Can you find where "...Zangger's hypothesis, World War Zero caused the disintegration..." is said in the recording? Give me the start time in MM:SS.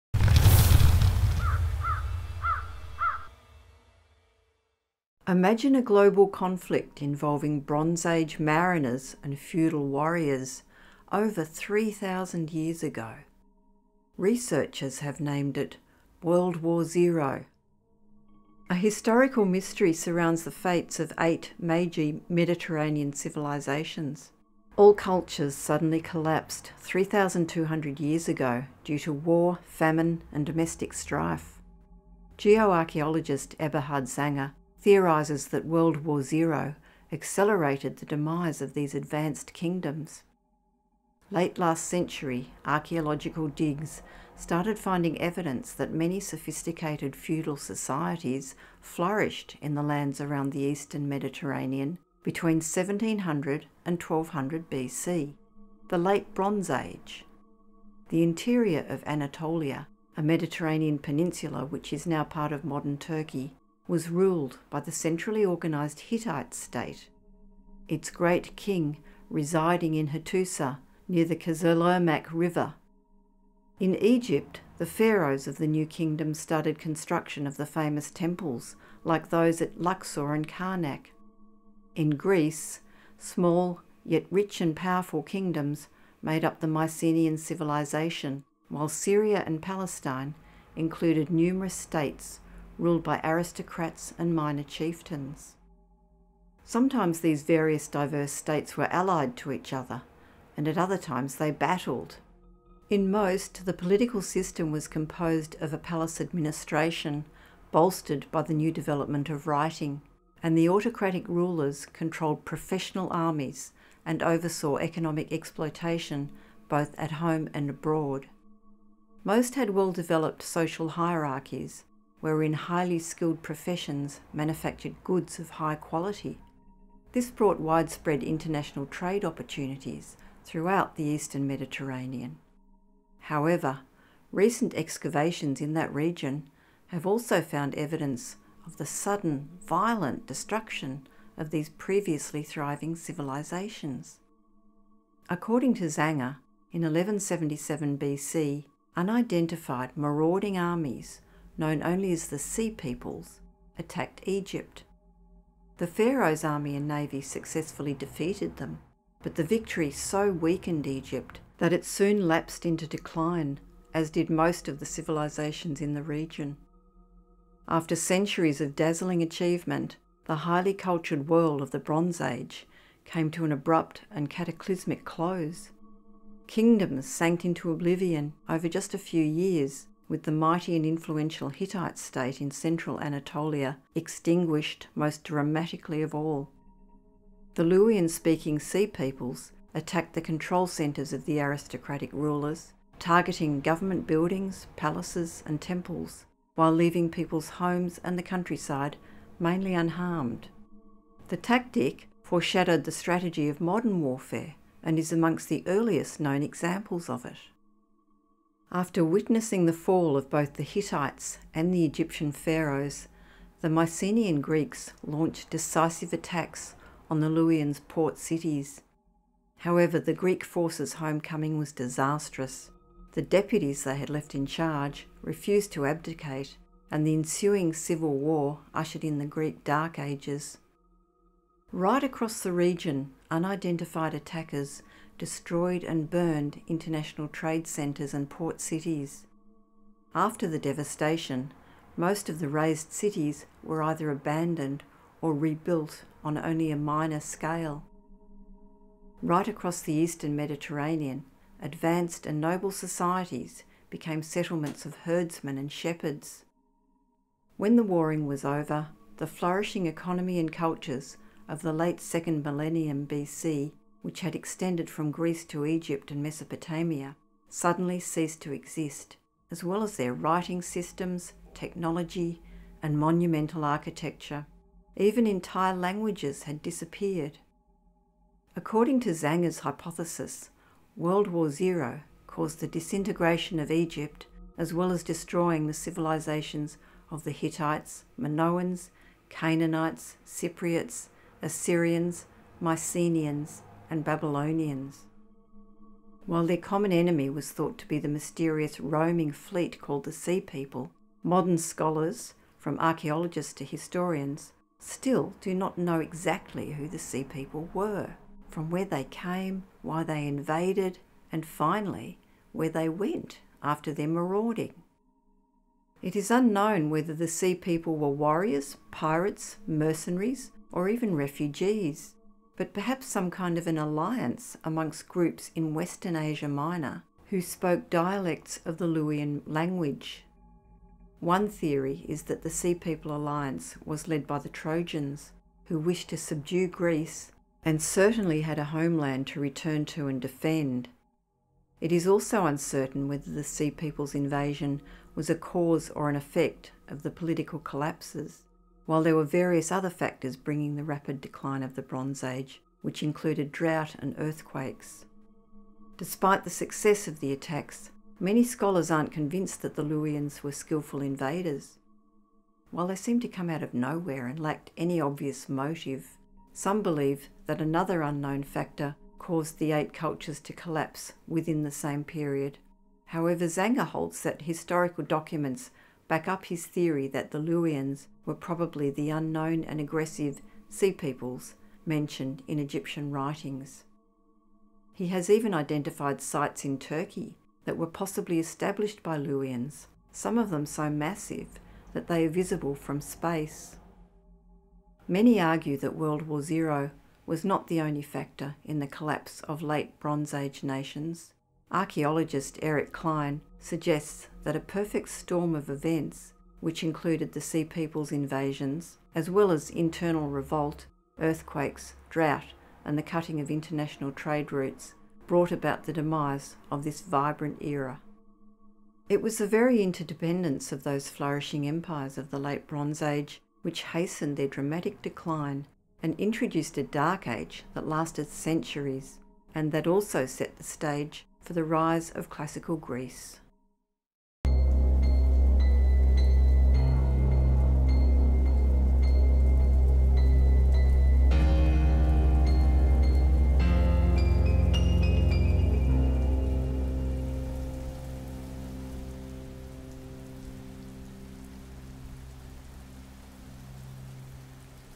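04:39.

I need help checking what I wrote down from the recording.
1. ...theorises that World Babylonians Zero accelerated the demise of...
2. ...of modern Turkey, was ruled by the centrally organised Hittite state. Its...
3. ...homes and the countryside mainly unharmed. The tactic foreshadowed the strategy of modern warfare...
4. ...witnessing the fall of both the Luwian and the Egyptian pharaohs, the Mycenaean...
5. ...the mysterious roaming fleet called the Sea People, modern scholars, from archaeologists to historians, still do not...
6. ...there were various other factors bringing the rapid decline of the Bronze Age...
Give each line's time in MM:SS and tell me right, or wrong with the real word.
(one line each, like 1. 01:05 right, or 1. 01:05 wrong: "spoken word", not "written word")
1. 00:34 wrong: "War", not "Babylonians"
2. 01:02 right
3. 03:17 right
4. 03:29 wrong: "Hittites", not "Luwian"
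5. 04:57 right
6. 05:49 right.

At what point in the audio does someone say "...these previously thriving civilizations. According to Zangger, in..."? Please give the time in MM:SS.
02:21.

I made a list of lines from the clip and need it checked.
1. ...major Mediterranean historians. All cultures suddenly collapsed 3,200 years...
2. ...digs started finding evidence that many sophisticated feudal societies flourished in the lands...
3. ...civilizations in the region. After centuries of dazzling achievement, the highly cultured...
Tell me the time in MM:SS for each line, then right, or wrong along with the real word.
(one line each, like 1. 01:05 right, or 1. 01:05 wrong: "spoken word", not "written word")
1. 00:21 wrong: "civilizations", not "historians"
2. 00:43 right
3. 02:44 right.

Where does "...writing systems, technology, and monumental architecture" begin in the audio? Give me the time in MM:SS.
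04:30.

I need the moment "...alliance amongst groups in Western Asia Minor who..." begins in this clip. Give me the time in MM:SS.
05:23.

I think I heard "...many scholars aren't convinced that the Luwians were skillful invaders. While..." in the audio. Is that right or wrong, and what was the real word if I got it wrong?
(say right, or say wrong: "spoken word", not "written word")
right.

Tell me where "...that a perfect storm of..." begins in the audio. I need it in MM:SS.
06:44.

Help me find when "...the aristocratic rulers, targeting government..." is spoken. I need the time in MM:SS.
03:11.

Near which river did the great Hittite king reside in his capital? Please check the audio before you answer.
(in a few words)
Kızılırmak River.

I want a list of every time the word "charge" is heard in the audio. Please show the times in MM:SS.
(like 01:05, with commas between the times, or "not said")
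03:44.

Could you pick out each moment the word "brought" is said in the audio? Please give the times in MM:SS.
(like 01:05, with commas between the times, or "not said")
02:07, 06:55.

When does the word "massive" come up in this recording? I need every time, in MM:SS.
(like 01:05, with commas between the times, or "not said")
06:30.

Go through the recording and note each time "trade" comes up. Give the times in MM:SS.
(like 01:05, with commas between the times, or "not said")
02:08, 03:57, 06:54.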